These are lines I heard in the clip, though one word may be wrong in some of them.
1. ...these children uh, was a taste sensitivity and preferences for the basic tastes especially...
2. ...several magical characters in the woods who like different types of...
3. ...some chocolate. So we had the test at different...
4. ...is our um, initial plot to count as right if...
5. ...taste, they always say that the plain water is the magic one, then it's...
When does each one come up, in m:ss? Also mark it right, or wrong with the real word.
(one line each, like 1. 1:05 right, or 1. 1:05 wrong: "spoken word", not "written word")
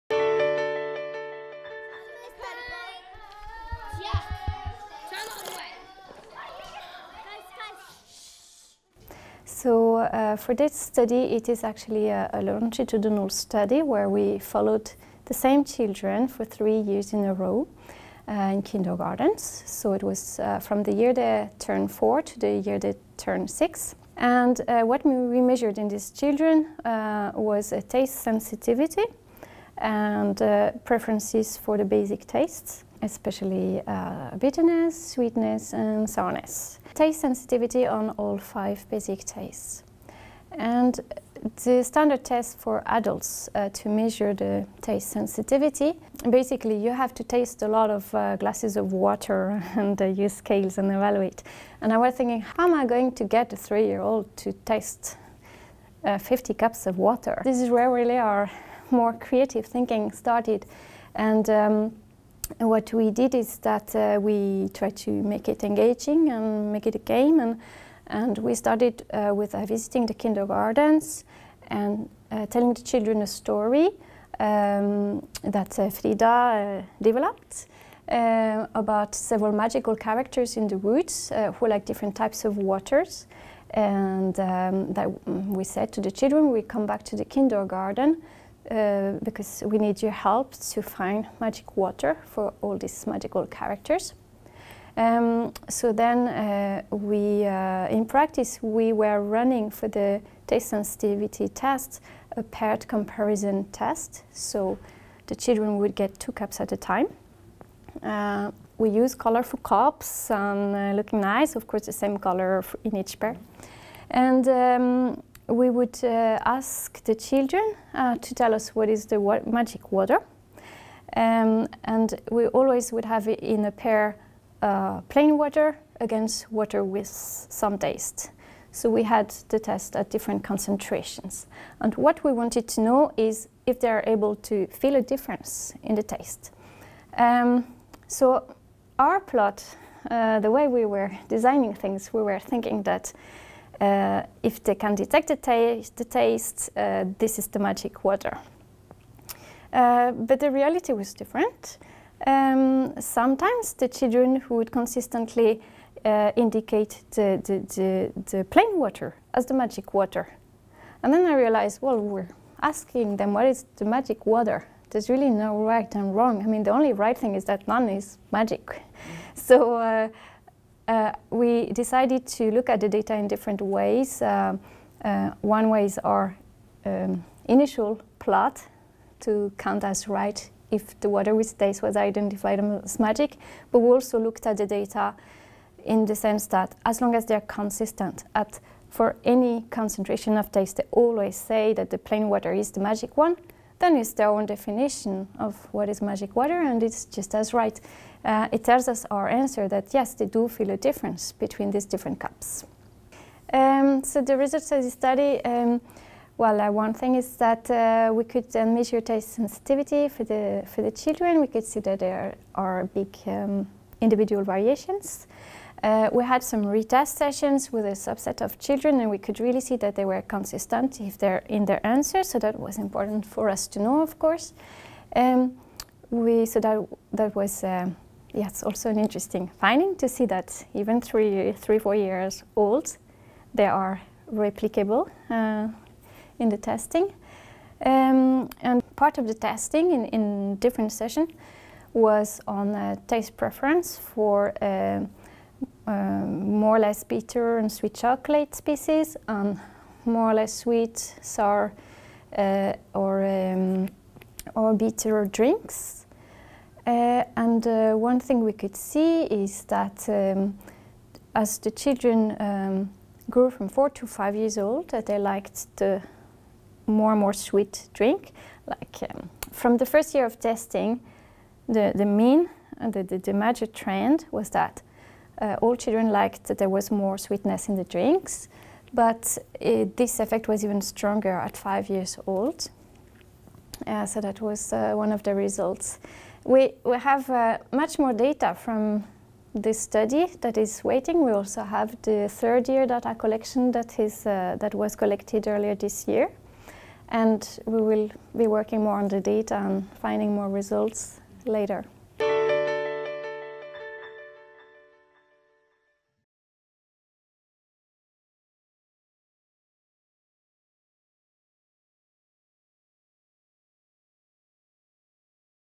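1. 0:25 right
2. 1:19 right
3. 2:07 wrong: "taste", not "chocolate"
4. 2:55 right
5. 3:10 right.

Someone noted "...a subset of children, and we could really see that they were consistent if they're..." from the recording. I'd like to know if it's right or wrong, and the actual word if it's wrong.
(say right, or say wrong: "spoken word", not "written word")
right.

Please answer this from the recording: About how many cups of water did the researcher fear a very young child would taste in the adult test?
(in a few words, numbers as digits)
50.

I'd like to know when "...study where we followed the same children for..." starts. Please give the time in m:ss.
0:13.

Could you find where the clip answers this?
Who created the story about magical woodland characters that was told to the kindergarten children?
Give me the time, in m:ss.
1:15.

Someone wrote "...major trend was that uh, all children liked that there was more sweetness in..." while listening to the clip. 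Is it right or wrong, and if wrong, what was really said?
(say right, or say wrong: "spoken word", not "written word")
right.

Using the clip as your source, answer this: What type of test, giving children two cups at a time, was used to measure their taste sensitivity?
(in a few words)
Paired comparison test.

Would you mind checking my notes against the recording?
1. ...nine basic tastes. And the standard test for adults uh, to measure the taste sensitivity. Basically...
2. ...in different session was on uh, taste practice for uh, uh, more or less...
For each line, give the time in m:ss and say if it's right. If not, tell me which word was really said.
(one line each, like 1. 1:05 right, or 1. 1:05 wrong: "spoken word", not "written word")
1. 0:38 wrong: "five", not "nine"
2. 4:00 wrong: "preference", not "practice".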